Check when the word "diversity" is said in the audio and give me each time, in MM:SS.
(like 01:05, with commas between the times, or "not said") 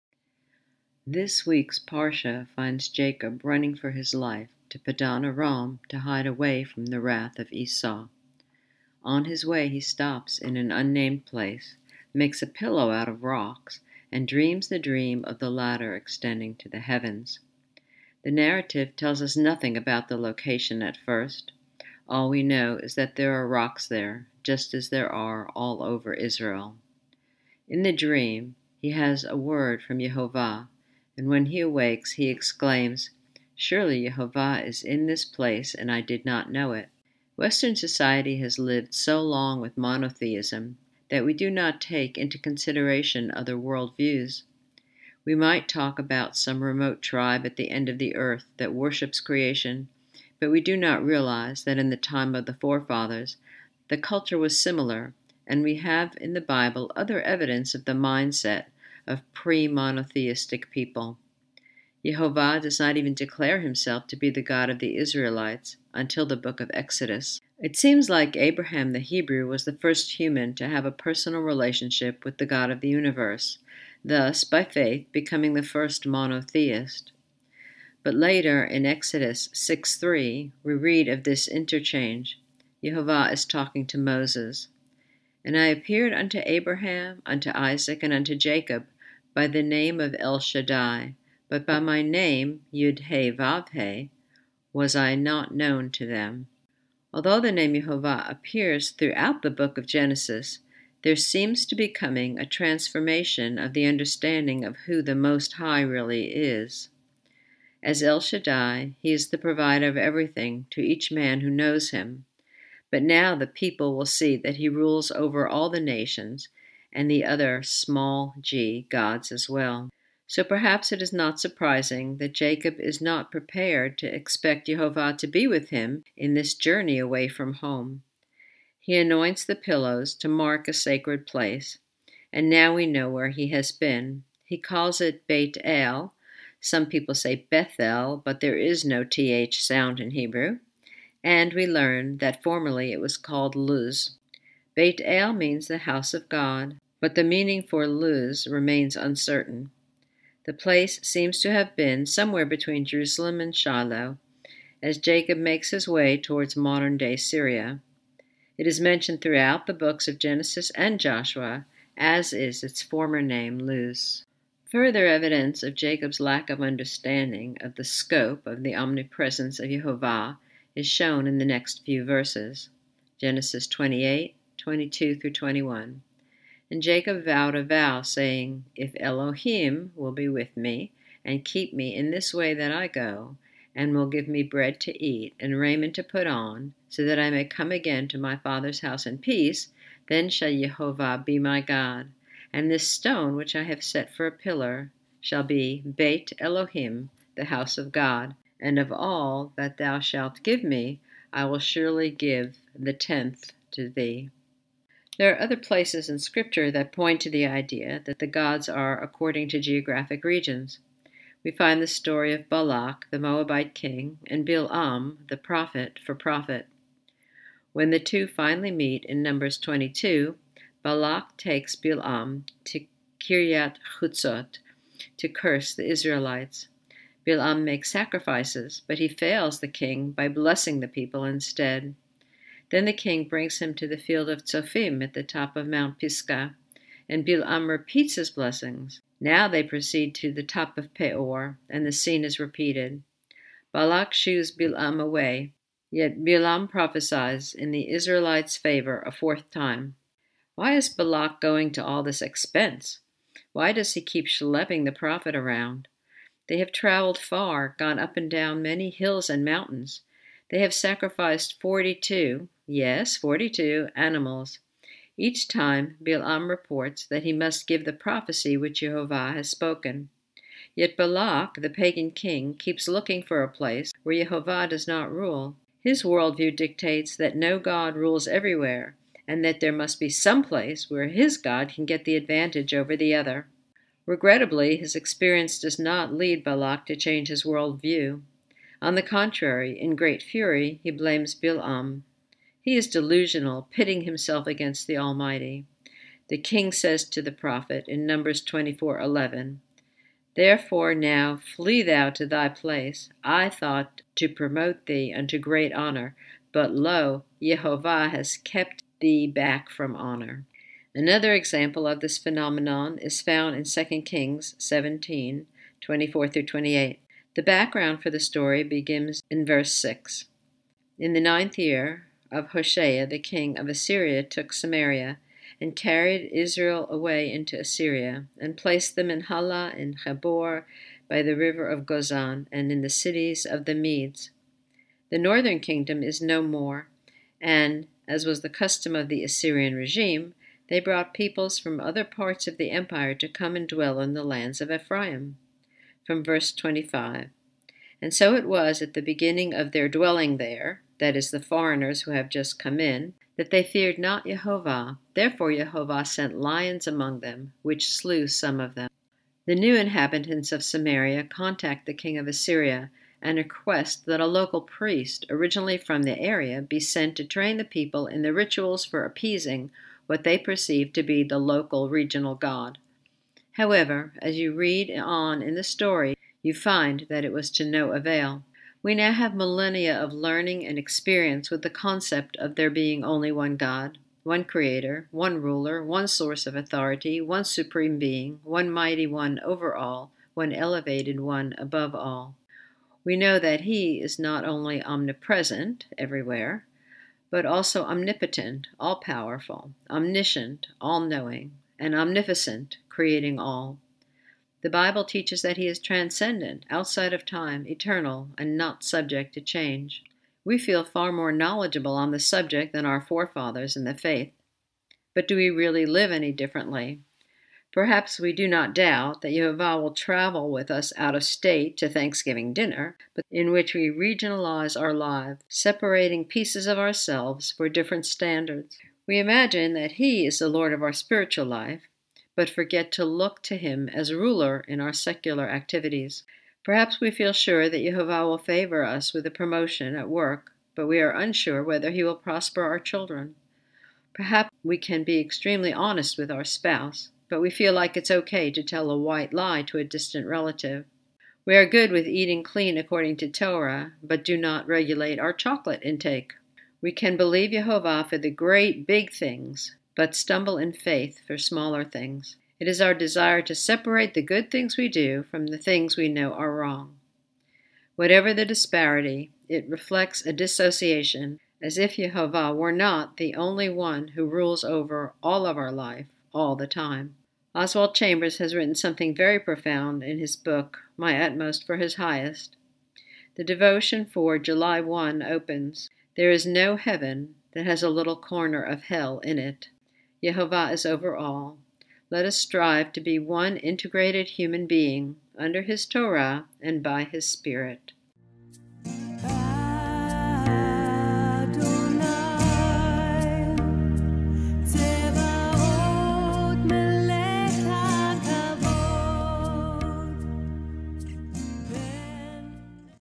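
not said.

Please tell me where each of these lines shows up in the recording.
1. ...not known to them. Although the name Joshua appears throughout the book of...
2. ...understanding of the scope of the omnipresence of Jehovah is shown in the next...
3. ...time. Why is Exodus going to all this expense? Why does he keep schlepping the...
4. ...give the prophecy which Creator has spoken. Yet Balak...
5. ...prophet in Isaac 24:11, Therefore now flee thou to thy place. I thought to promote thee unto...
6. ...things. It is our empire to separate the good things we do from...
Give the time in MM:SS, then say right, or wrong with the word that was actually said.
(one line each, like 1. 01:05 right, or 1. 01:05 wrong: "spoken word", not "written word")
1. 01:35 wrong: "Jehovah", not "Joshua"
2. 02:46 right
3. 04:09 wrong: "Balak", not "Exodus"
4. 04:27 wrong: "Jehovah", not "Creator"
5. 04:57 wrong: "Numbers", not "Isaac"
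6. 07:41 wrong: "desire", not "empire".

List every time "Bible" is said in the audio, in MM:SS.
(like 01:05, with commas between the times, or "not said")
00:56, 06:44.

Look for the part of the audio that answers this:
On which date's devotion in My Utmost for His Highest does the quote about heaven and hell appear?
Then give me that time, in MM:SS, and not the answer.
08:04.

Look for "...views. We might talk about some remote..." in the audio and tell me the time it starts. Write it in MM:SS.
00:43.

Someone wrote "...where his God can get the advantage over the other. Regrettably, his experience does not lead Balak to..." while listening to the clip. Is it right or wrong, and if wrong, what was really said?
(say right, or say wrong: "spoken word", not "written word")
right.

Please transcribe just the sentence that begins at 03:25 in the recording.
There are other places in Scripture that point to the idea that the gods are according to geographic regions.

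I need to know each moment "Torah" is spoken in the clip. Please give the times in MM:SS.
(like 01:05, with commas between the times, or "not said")
07:33, 08:15.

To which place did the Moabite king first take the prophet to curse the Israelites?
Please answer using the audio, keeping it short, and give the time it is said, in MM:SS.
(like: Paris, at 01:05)
Kiryat Chutzot, at 03:43.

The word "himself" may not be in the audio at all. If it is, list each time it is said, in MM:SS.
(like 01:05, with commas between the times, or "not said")
01:03, 04:54.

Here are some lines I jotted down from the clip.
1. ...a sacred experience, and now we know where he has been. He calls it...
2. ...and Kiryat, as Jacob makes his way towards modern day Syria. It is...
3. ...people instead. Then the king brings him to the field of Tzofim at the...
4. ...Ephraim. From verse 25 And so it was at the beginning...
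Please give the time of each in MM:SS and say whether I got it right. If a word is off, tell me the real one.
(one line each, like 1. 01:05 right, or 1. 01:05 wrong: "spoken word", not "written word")
1. 02:10 wrong: "place", not "experience"
2. 02:33 wrong: "Shiloh", not "Kiryat"
3. 03:50 right
4. 05:44 right.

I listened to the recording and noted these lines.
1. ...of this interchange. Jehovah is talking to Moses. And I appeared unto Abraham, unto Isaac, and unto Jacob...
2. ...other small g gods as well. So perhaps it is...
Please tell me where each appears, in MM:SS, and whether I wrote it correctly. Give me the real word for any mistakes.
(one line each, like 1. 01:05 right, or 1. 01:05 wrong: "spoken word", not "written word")
1. 01:21 right
2. 01:57 right.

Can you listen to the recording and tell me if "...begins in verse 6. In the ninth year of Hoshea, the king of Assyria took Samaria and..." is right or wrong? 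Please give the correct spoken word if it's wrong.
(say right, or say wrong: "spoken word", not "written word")
right.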